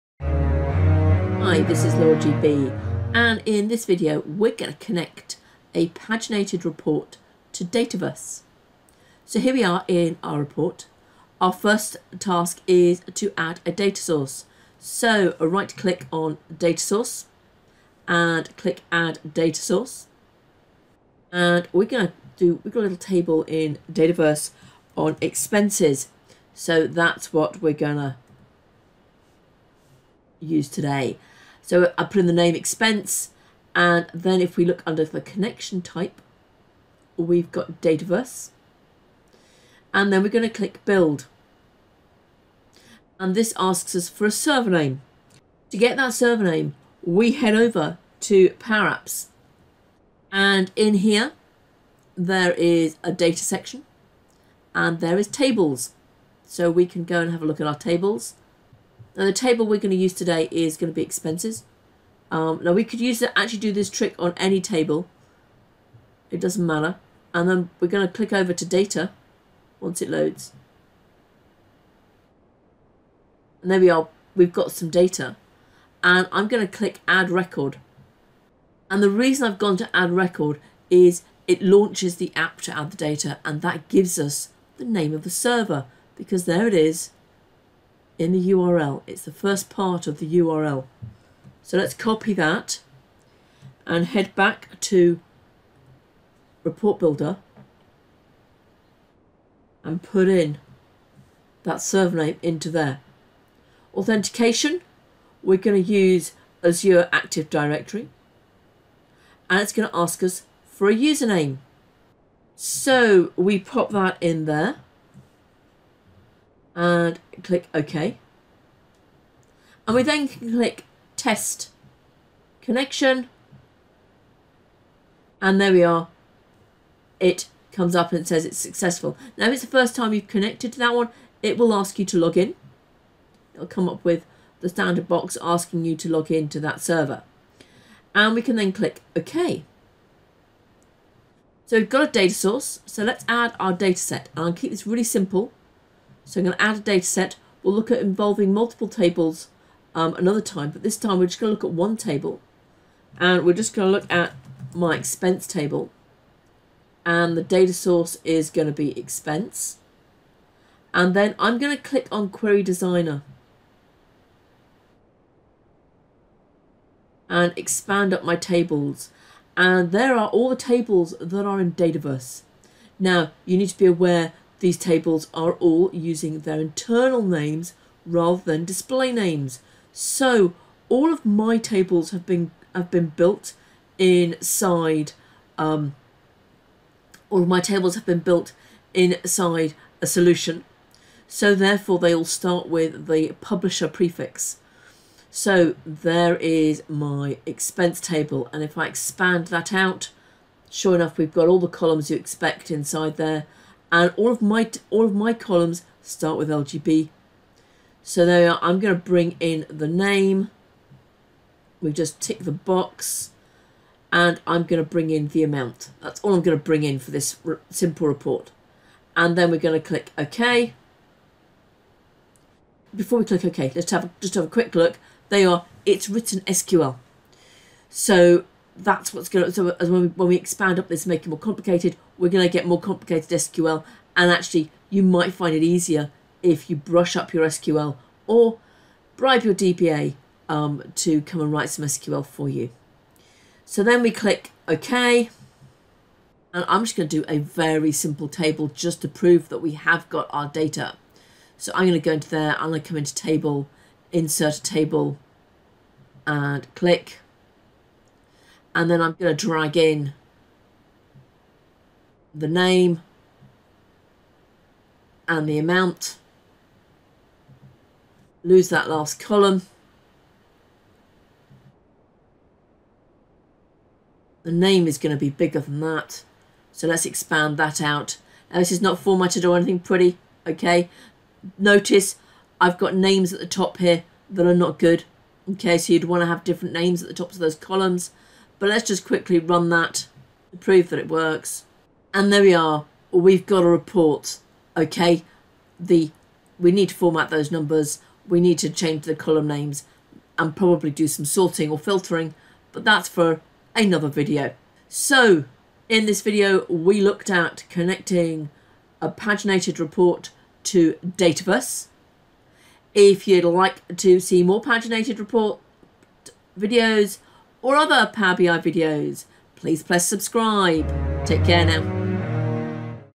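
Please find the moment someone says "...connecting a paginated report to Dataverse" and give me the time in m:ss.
5:07.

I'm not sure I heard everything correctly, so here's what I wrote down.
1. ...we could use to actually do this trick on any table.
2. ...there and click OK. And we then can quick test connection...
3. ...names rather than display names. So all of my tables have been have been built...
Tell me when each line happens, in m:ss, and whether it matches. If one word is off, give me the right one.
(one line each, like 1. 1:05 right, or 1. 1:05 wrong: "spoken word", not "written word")
1. 1:02 right
2. 1:54 wrong: "click", not "quick"
3. 2:57 right.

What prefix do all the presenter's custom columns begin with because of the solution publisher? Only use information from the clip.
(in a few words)
LGB.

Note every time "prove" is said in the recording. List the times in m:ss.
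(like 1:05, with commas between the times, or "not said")
4:09, 4:50.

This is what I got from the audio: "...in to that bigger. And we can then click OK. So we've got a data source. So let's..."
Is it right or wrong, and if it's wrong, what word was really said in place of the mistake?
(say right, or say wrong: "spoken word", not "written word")
wrong: "server", not "bigger".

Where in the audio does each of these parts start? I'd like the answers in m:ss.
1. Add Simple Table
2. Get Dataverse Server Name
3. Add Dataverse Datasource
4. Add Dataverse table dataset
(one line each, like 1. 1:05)
1. 4:06
2. 0:43
3. 0:11
4. 2:21.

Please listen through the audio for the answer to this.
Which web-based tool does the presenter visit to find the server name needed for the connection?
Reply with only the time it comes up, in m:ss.
0:47.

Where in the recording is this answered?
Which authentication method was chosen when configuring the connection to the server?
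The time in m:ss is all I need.
1:46.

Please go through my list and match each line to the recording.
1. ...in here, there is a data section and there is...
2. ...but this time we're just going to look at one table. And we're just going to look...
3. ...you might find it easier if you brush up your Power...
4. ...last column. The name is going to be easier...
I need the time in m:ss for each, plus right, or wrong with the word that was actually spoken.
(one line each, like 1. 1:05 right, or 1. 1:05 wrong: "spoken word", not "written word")
1. 0:50 right
2. 2:30 right
3. 3:54 wrong: "SQL", not "Power"
4. 4:28 wrong: "bigger", not "easier".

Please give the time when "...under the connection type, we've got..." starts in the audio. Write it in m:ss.
0:34.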